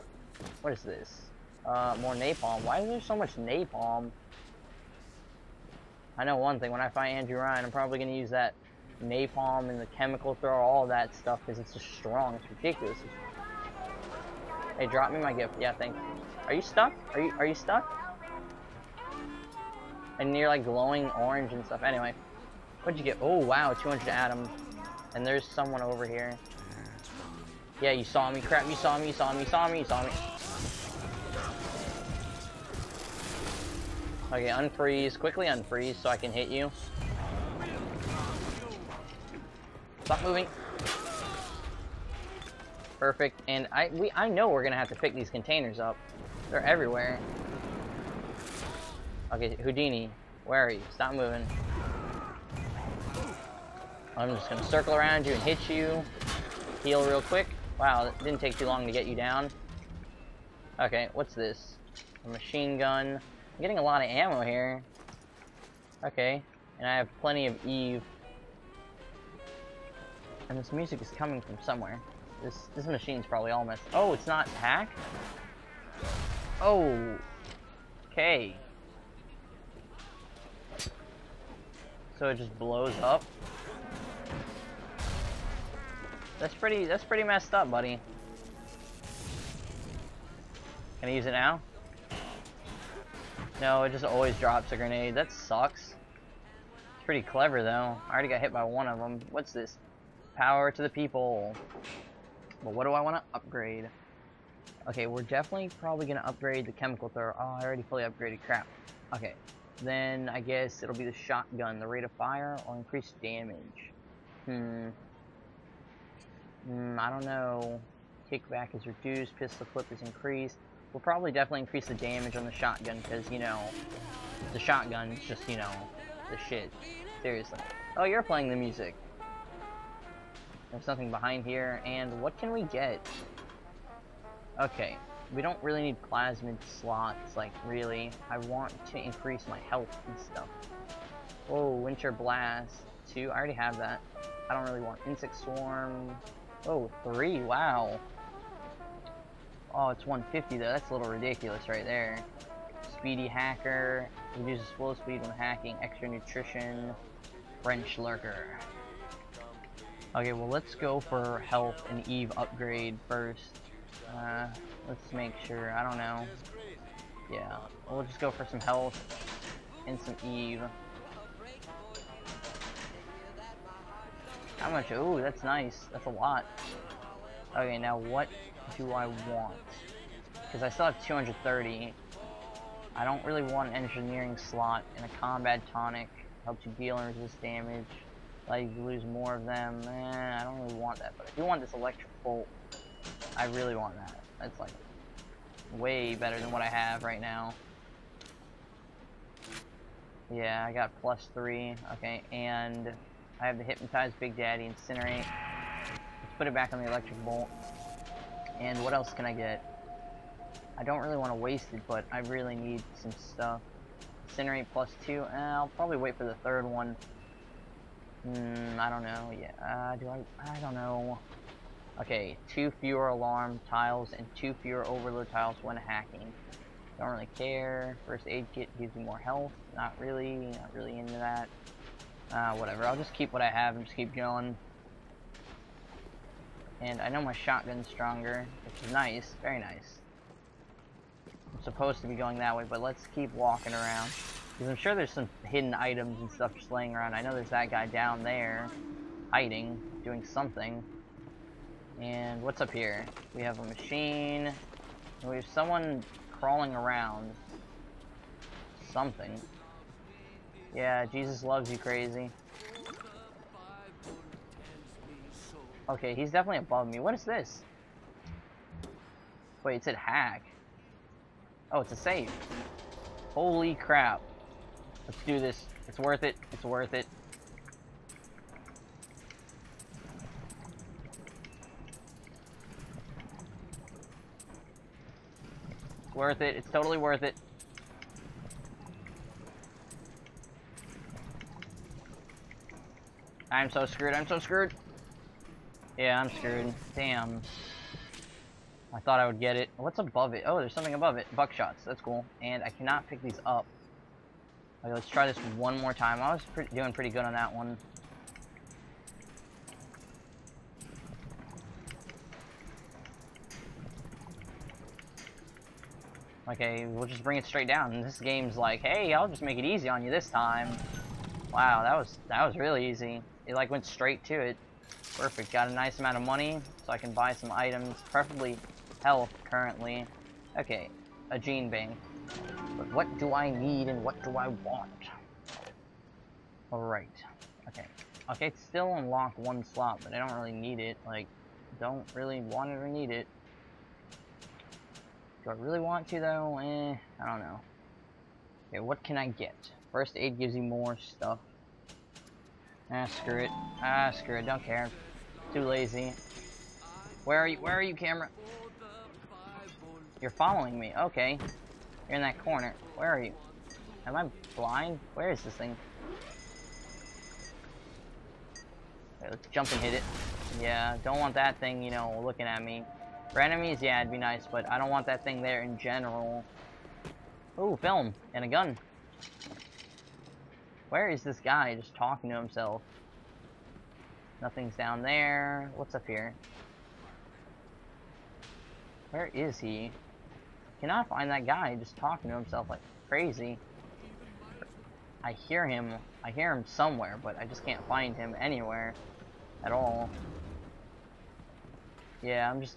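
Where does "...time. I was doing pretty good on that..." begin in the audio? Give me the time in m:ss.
5:05.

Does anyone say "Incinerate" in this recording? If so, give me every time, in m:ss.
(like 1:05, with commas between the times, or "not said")
3:24, 3:34.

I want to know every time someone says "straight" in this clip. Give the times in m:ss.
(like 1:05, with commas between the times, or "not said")
5:17, 5:23.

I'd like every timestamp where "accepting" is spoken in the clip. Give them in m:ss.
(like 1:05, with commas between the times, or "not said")
not said.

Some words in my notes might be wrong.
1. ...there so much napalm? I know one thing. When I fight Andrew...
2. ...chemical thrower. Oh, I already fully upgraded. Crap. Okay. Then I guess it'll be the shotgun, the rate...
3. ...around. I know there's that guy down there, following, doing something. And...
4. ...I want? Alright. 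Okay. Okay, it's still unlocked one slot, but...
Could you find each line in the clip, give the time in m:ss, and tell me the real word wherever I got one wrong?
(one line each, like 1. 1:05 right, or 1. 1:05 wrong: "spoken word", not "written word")
1. 0:02 right
2. 1:46 right
3. 4:06 wrong: "hiding", not "following"
4. 5:34 right.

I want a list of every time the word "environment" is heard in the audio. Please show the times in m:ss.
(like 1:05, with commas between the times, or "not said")
not said.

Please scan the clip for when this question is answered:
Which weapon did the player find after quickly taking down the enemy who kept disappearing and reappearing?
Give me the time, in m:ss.
1:02.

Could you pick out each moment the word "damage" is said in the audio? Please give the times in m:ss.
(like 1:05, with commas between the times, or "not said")
1:53, 2:01, 3:07.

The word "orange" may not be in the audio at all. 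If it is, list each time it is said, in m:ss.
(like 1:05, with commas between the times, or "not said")
0:21.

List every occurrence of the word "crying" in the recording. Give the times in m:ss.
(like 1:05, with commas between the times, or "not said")
not said.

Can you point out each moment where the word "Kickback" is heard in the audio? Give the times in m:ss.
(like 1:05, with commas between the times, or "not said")
1:58.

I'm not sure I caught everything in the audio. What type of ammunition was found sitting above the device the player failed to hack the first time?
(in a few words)
Buckshots.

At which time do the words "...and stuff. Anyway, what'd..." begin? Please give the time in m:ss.
0:21.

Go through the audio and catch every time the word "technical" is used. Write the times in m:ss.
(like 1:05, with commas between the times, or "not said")
not said.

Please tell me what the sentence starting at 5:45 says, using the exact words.
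Do I really want to though?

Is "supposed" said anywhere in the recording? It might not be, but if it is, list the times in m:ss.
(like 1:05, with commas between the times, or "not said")
4:01.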